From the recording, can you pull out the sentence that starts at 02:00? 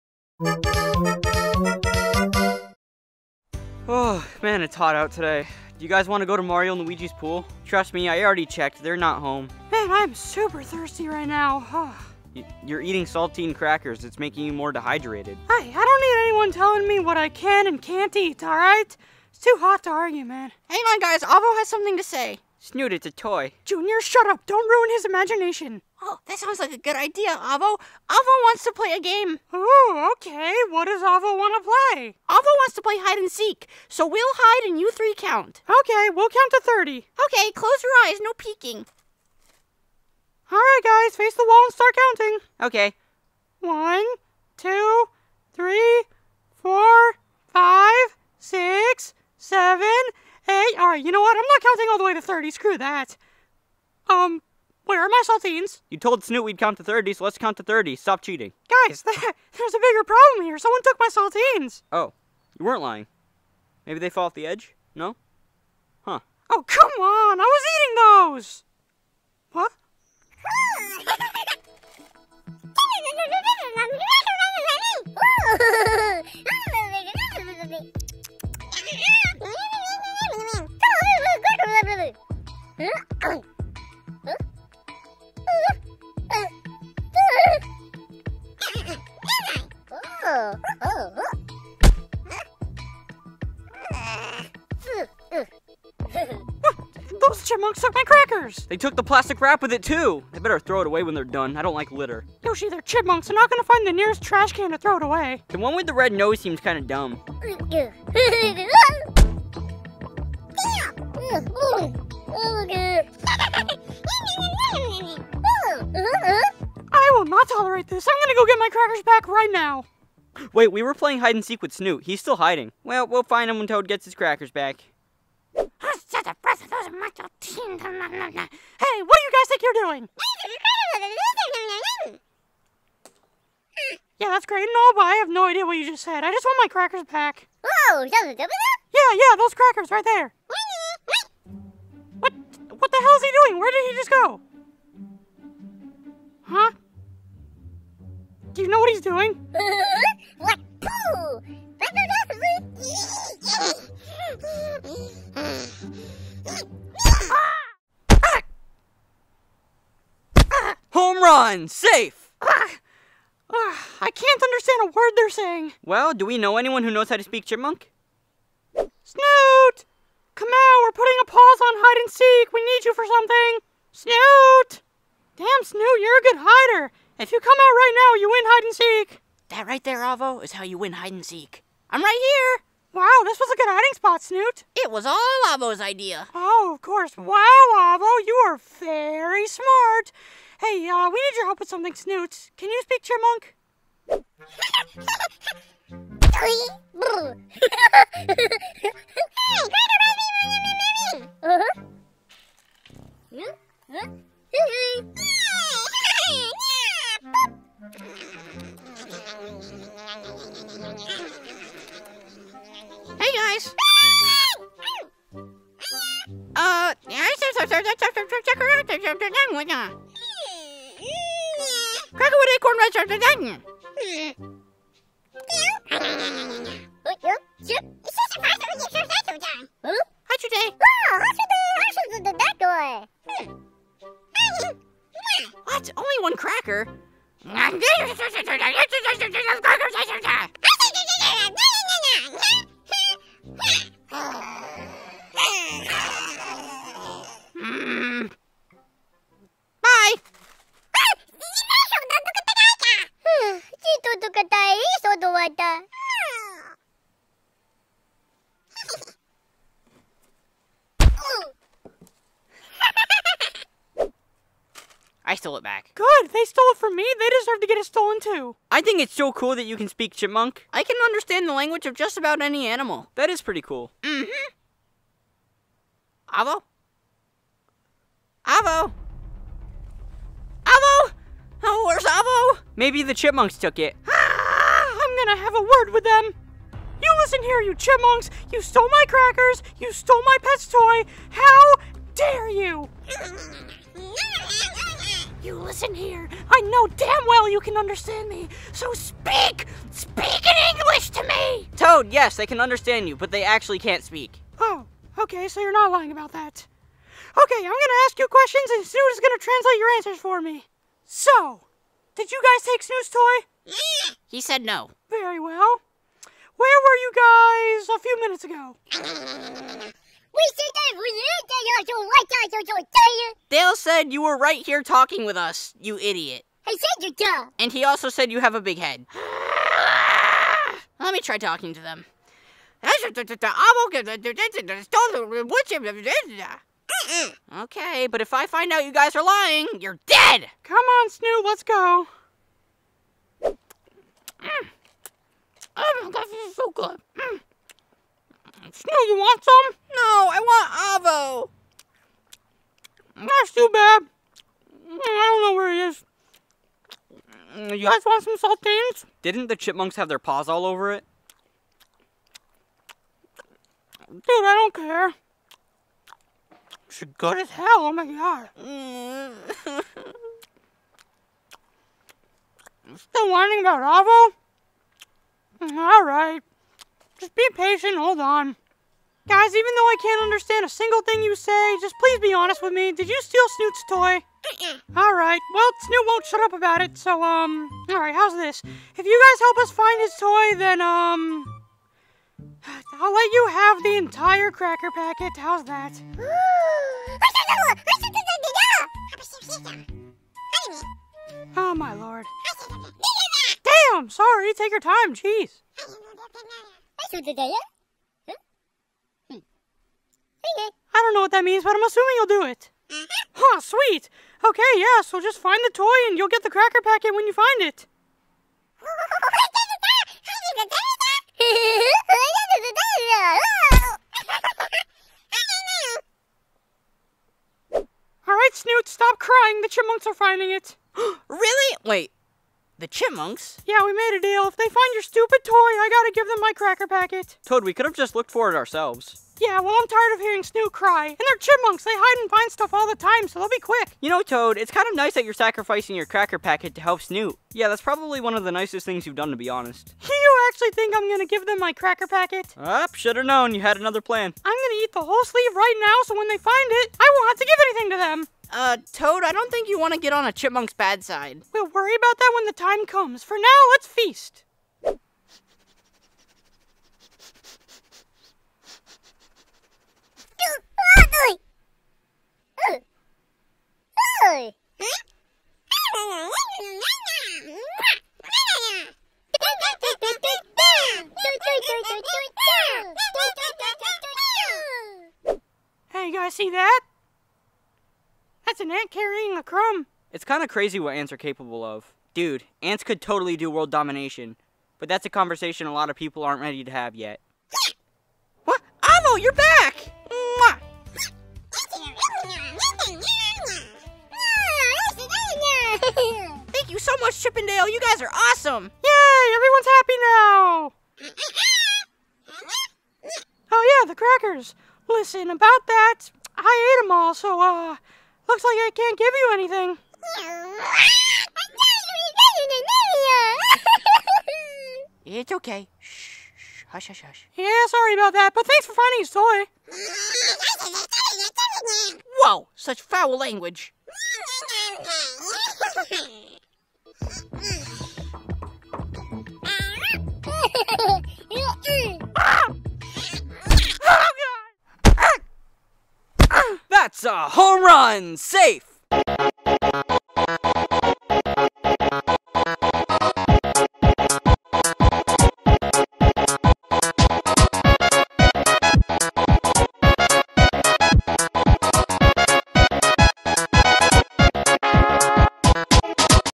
Wait, we were playing hide and seek with Snoot.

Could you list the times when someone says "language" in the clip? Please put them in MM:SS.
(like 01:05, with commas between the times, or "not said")
04:31, 08:53.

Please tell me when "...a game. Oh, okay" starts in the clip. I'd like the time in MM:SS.
00:28.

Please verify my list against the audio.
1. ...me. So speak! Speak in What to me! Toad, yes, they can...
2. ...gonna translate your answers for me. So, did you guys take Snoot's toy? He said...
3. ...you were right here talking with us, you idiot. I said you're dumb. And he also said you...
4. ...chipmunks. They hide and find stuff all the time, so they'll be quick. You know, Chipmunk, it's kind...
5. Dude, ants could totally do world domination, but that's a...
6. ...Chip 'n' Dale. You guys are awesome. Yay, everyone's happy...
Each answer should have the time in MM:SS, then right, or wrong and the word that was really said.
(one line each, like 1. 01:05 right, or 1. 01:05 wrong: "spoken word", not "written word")
1. 04:58 wrong: "English", not "What"
2. 05:09 right
3. 05:24 right
4. 07:21 wrong: "Toad", not "Chipmunk"
5. 08:12 right
6. 08:27 right.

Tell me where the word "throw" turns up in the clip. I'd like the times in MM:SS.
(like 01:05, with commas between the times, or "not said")
01:40, 01:44.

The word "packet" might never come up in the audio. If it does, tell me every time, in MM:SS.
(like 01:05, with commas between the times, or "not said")
06:34, 06:56, 07:16, 07:26, 07:32.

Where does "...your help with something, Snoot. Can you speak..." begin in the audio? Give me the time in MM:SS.
03:11.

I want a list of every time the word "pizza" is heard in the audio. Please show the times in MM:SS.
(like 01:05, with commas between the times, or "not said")
not said.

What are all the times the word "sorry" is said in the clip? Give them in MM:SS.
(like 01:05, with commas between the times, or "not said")
06:44, 08:47.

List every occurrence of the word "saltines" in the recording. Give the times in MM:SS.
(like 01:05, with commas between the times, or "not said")
00:13, 00:55, 01:01, 05:58.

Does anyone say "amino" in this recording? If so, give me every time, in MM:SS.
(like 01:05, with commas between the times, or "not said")
not said.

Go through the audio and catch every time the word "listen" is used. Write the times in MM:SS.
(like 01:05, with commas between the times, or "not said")
04:47, 04:55, 08:34.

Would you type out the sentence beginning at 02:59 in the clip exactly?
That right there, Avo, is how you win hide and seek.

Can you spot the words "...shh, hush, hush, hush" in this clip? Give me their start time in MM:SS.
08:46.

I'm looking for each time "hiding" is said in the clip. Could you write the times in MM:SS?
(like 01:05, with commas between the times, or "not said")
02:02, 03:03.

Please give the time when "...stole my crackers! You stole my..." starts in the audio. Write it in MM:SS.
04:48.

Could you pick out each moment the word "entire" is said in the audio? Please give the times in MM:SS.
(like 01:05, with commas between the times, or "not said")
06:33.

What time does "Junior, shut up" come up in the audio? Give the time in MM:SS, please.
00:23.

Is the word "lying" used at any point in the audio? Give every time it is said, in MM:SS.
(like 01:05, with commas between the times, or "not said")
01:02, 05:05, 05:39.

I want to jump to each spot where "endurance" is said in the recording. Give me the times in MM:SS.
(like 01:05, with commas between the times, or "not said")
not said.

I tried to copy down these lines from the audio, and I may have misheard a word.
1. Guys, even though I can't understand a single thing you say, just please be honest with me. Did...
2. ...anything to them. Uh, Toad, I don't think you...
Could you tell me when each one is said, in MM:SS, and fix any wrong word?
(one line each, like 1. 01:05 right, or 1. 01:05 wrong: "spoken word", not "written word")
1. 06:19 right
2. 07:37 right.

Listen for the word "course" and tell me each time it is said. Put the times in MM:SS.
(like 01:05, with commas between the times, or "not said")
03:06.